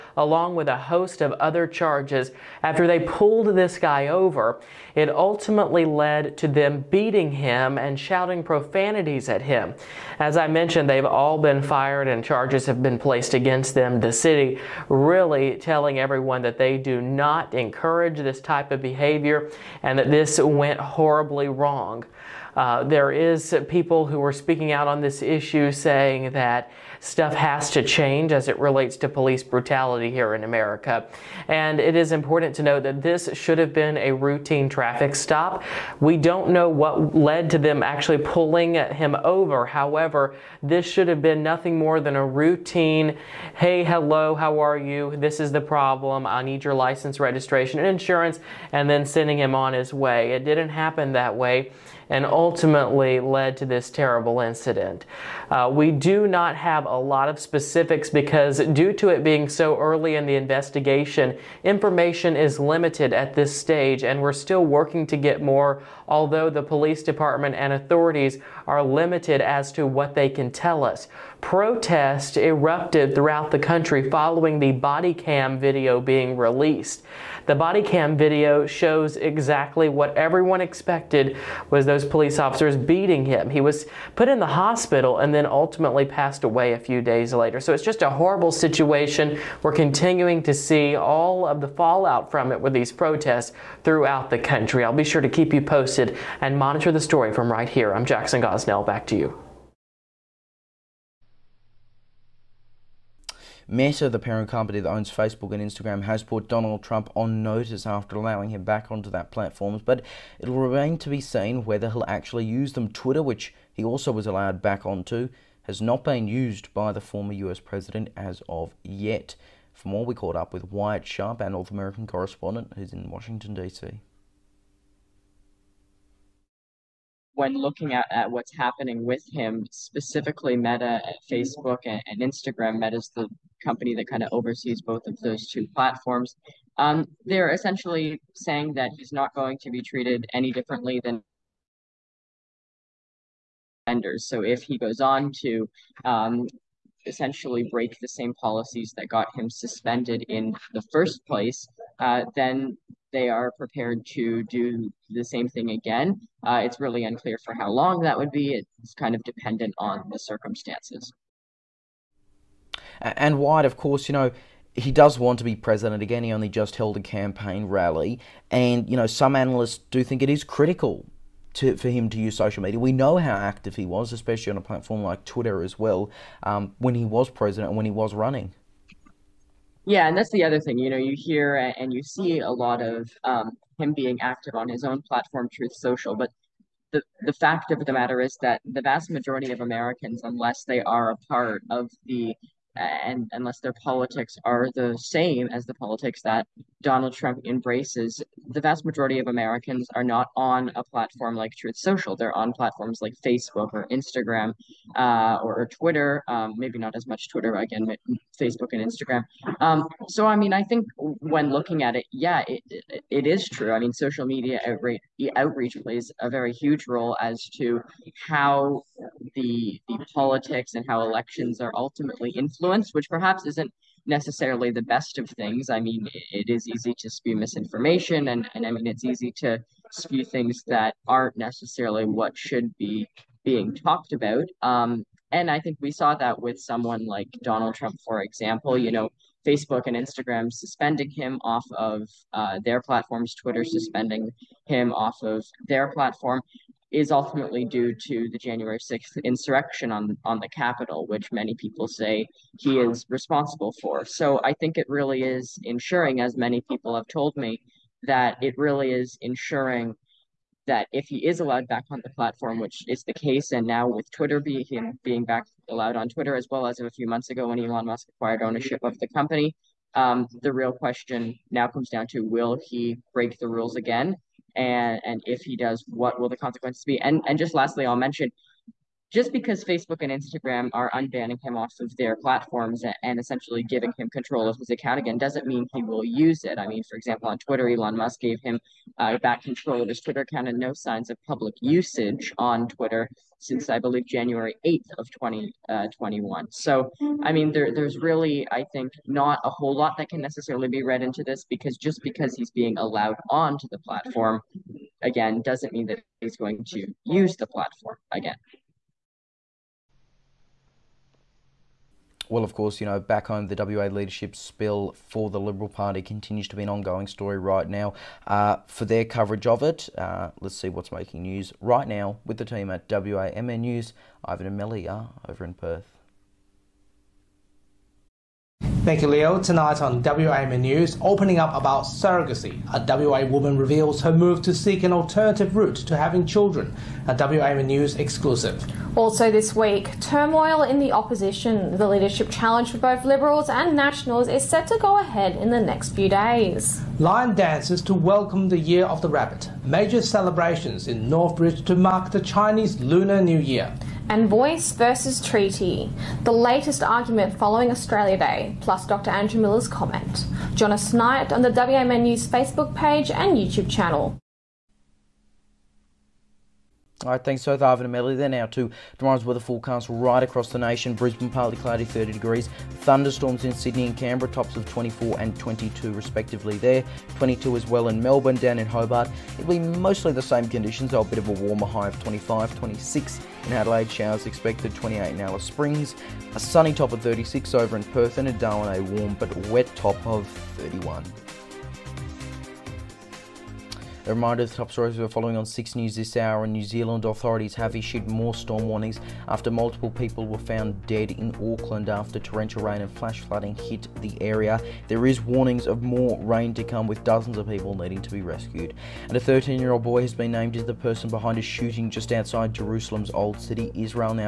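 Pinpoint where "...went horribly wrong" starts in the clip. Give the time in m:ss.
0:20.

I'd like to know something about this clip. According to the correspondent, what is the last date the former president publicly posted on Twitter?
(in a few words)
January 8th, 2021.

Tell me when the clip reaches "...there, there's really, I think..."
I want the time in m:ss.
4:57.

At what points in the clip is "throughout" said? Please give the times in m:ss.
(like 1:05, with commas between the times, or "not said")
1:13, 1:33.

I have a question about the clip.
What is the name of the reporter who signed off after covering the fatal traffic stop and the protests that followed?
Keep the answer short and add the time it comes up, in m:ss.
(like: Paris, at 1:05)
Jackson Gosnell, at 1:38.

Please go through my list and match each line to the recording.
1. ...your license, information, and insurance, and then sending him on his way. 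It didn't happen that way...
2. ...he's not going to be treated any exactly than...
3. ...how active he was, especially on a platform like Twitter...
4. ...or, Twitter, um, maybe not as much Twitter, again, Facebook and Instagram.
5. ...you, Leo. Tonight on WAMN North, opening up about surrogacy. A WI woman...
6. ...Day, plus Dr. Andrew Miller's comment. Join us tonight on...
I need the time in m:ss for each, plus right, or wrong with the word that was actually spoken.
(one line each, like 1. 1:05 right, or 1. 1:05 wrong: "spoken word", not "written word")
1. 0:46 wrong: "registration", not "information"
2. 2:18 wrong: "differently", not "exactly"
3. 2:53 right
4. 3:25 right
5. 5:29 wrong: "News", not "North"
6. 5:58 right.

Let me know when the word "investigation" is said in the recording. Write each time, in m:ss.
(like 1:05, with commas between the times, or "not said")
1:00.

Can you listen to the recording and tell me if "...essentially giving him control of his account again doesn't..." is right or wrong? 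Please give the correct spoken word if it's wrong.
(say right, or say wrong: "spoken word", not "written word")
right.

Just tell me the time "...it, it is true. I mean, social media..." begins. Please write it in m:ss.
3:32.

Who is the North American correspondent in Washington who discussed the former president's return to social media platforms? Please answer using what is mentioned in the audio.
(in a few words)
Wyatt Sharp.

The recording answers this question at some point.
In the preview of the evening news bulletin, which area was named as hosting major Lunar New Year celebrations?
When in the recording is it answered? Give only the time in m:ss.
5:51.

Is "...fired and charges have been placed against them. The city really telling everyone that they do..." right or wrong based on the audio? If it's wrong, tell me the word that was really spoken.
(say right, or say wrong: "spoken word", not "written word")
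right.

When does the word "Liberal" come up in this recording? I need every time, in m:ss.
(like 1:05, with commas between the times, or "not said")
5:15, 5:43.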